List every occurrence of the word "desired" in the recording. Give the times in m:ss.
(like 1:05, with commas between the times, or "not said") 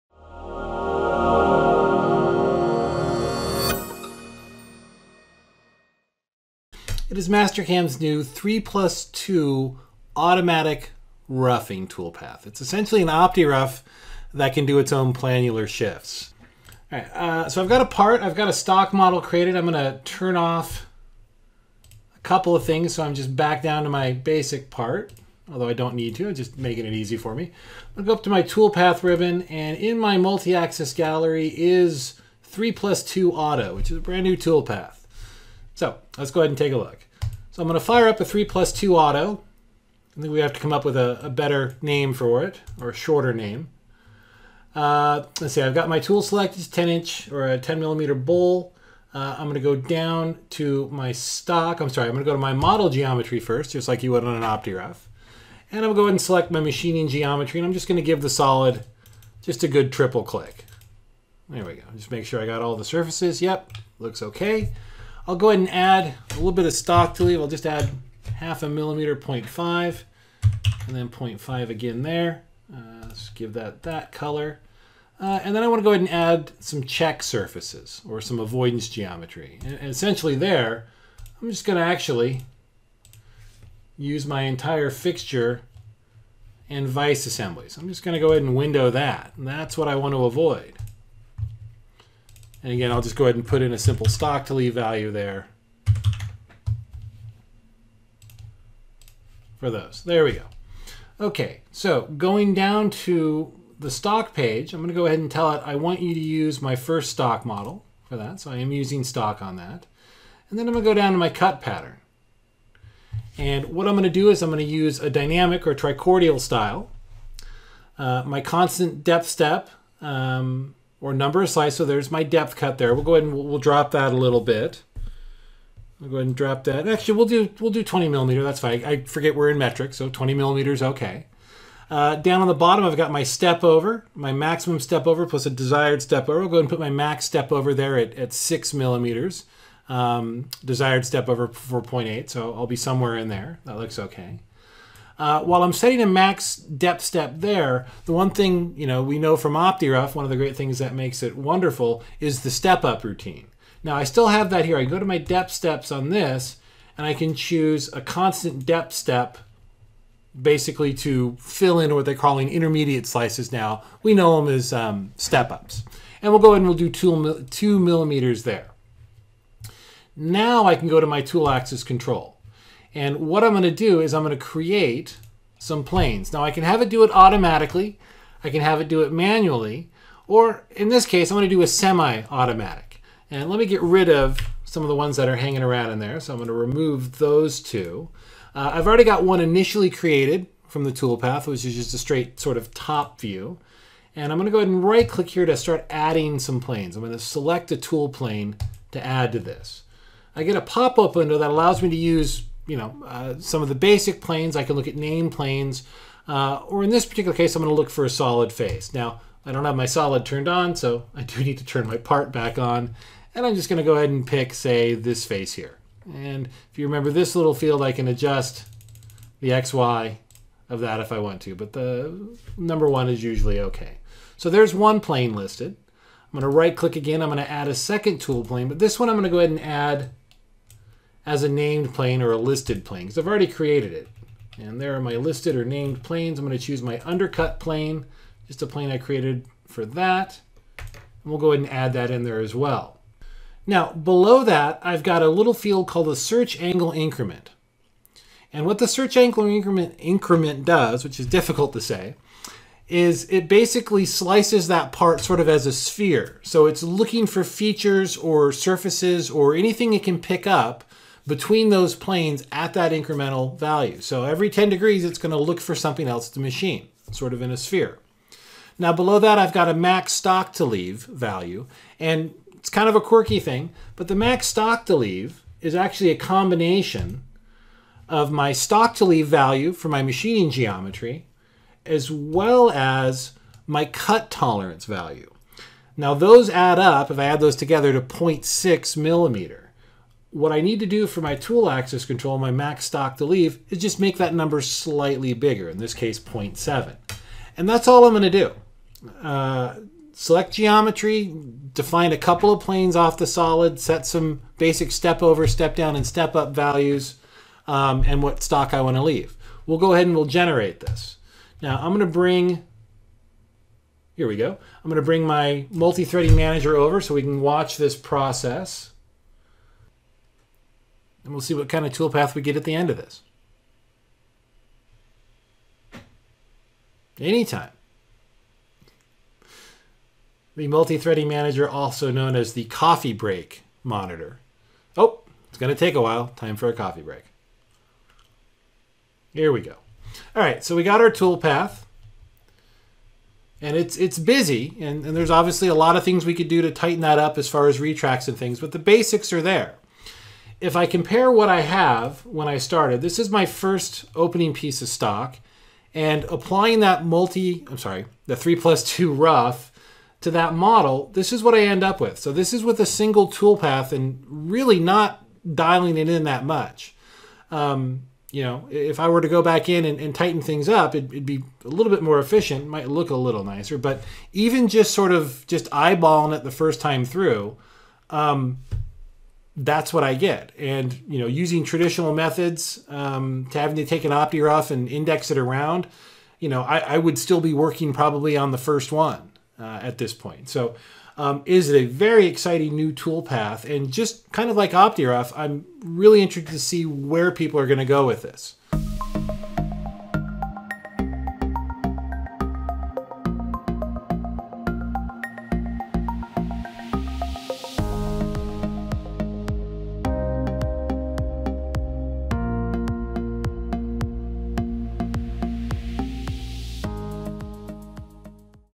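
2:15, 2:20.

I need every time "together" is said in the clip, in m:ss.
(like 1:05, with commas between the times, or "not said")
4:47.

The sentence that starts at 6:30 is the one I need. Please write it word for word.
So, um, is it a very exciting new tool path?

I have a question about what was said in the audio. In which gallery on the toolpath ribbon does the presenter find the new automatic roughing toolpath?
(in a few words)
multi-axis gallery.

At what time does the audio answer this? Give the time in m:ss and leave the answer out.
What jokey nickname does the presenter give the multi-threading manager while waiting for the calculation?
5:32.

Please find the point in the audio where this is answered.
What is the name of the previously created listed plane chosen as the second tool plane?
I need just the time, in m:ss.
3:57.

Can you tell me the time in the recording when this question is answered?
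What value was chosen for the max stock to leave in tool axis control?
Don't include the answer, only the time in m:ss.
4:56.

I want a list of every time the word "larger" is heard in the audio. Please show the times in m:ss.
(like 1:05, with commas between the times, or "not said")
not said.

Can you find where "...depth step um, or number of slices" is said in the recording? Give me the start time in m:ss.
1:59.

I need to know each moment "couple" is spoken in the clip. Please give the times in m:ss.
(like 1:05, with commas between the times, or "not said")
0:22, 5:02.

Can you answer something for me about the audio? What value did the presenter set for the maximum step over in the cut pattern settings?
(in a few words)
6 millimeters.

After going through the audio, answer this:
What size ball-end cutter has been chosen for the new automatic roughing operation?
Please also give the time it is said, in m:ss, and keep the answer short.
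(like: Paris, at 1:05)
10 millimeter, at 0:47.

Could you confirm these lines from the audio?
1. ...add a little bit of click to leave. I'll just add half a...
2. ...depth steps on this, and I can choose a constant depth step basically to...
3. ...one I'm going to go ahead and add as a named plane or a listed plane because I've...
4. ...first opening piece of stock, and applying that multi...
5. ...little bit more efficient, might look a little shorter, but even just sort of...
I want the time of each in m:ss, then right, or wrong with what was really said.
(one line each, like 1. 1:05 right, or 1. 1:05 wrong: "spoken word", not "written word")
1. 1:05 wrong: "stock", not "click"
2. 2:35 right
3. 3:48 right
4. 5:53 right
5. 6:11 wrong: "nicer", not "shorter".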